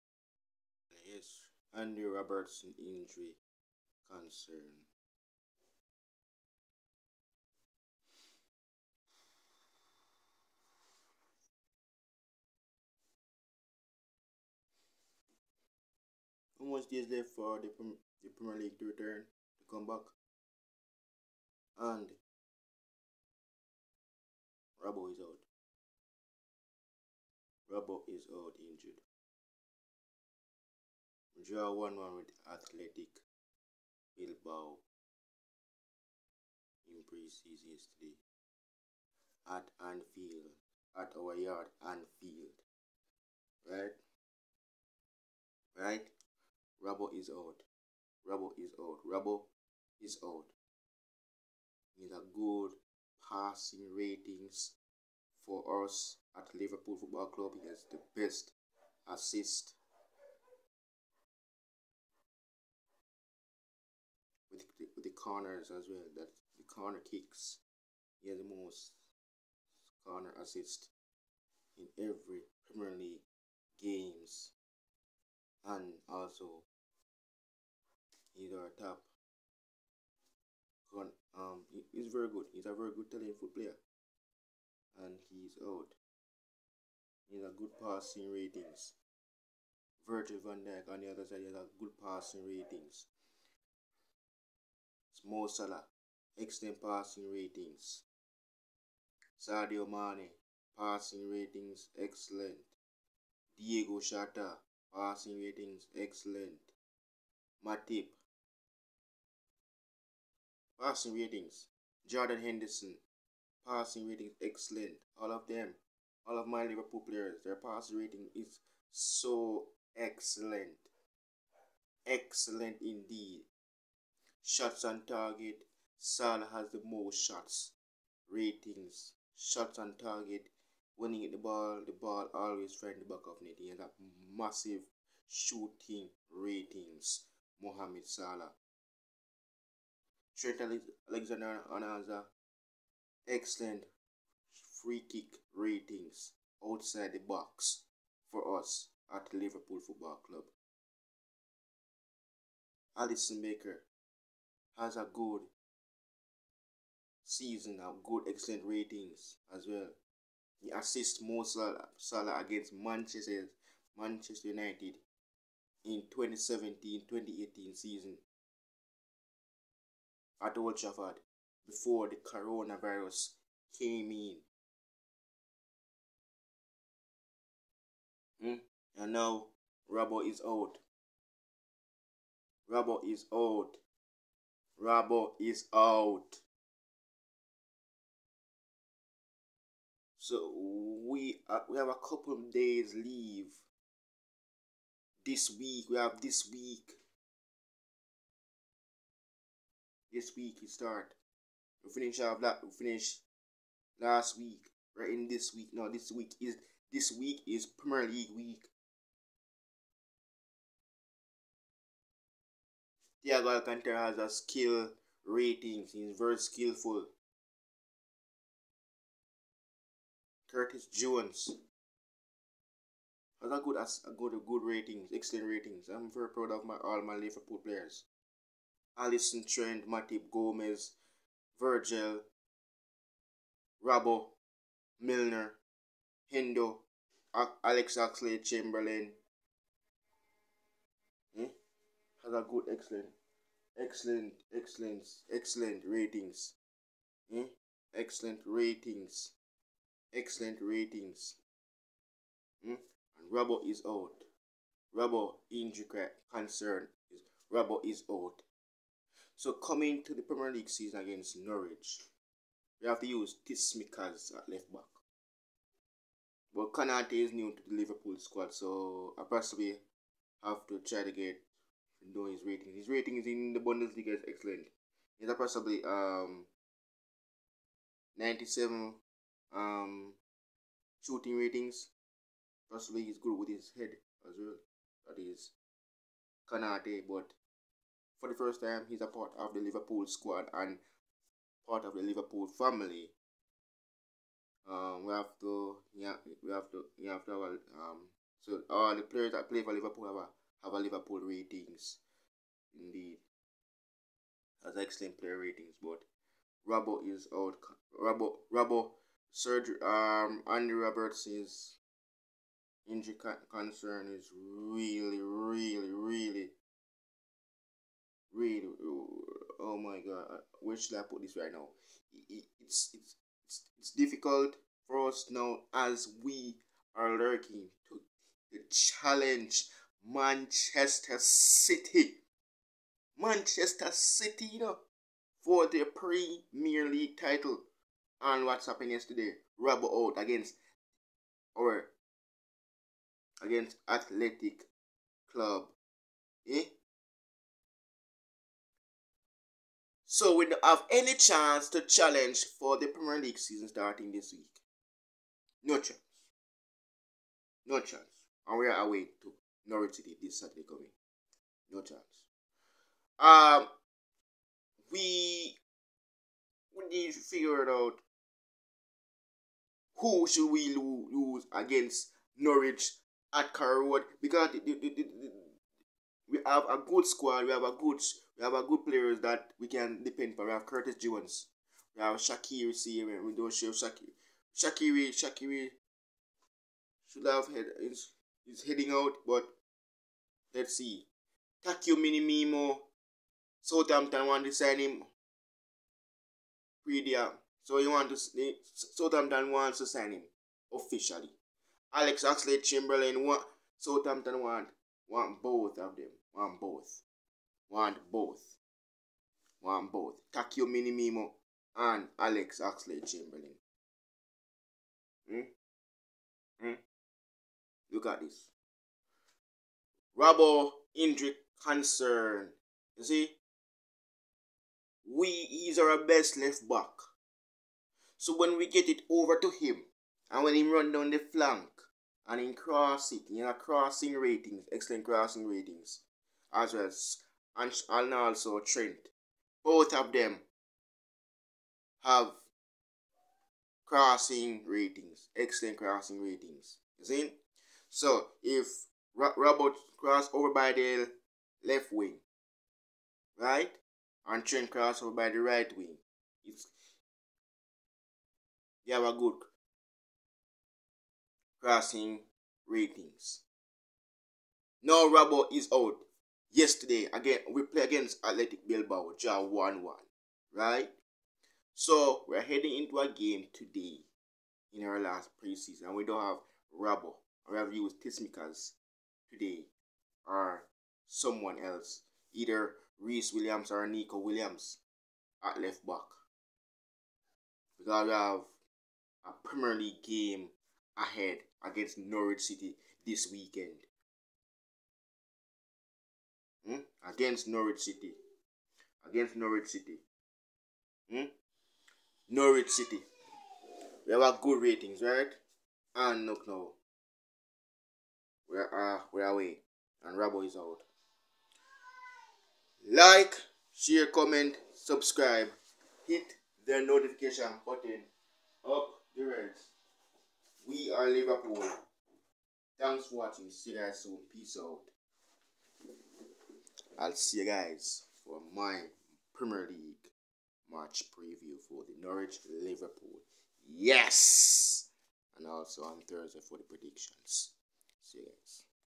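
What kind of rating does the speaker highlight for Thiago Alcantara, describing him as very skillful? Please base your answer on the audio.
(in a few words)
Skill rating.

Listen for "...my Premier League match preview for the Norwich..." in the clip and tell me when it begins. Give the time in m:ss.
8:48.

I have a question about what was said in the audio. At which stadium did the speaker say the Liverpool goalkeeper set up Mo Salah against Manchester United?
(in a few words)
Old Trafford.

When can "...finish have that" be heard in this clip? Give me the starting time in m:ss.
3:21.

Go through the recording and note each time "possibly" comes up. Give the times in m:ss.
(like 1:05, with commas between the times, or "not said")
4:29, 4:35, 4:42.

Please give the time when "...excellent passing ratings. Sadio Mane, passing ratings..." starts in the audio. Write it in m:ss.
1:36.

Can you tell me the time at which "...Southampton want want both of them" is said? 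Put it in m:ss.
6:43.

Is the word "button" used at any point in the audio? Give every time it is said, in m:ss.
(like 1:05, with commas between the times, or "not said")
8:37.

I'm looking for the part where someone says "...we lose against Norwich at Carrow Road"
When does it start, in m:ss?
6:10.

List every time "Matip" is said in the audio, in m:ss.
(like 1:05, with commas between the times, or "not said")
1:47, 3:49.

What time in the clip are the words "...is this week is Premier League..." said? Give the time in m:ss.
3:26.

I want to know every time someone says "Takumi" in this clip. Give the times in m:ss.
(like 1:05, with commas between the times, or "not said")
6:31, 6:50.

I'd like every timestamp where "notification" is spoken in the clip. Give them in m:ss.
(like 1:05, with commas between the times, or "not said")
8:36.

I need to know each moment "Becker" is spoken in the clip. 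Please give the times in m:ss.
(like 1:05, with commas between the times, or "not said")
2:33.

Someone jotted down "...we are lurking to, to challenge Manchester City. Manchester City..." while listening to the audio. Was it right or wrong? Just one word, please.
right.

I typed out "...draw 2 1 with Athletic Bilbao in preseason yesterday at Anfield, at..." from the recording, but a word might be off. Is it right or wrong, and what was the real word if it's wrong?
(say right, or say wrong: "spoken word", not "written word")
wrong: "1", not "2".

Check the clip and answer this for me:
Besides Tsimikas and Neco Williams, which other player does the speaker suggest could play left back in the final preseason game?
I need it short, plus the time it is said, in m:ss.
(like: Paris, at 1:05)
Rhys Williams, at 8:02.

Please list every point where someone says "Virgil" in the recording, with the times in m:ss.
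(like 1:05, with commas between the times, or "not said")
1:30, 3:51.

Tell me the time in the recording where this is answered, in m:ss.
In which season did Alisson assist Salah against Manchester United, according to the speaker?
2:46.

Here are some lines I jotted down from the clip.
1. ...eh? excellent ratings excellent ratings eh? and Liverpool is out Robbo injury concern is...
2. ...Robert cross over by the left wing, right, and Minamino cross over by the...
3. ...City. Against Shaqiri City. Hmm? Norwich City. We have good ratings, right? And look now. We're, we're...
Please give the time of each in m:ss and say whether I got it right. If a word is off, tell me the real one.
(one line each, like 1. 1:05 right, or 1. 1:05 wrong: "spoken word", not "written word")
1. 4:07 wrong: "Robbo", not "Liverpool"
2. 7:29 wrong: "Trent", not "Minamino"
3. 8:17 wrong: "Norwich", not "Shaqiri".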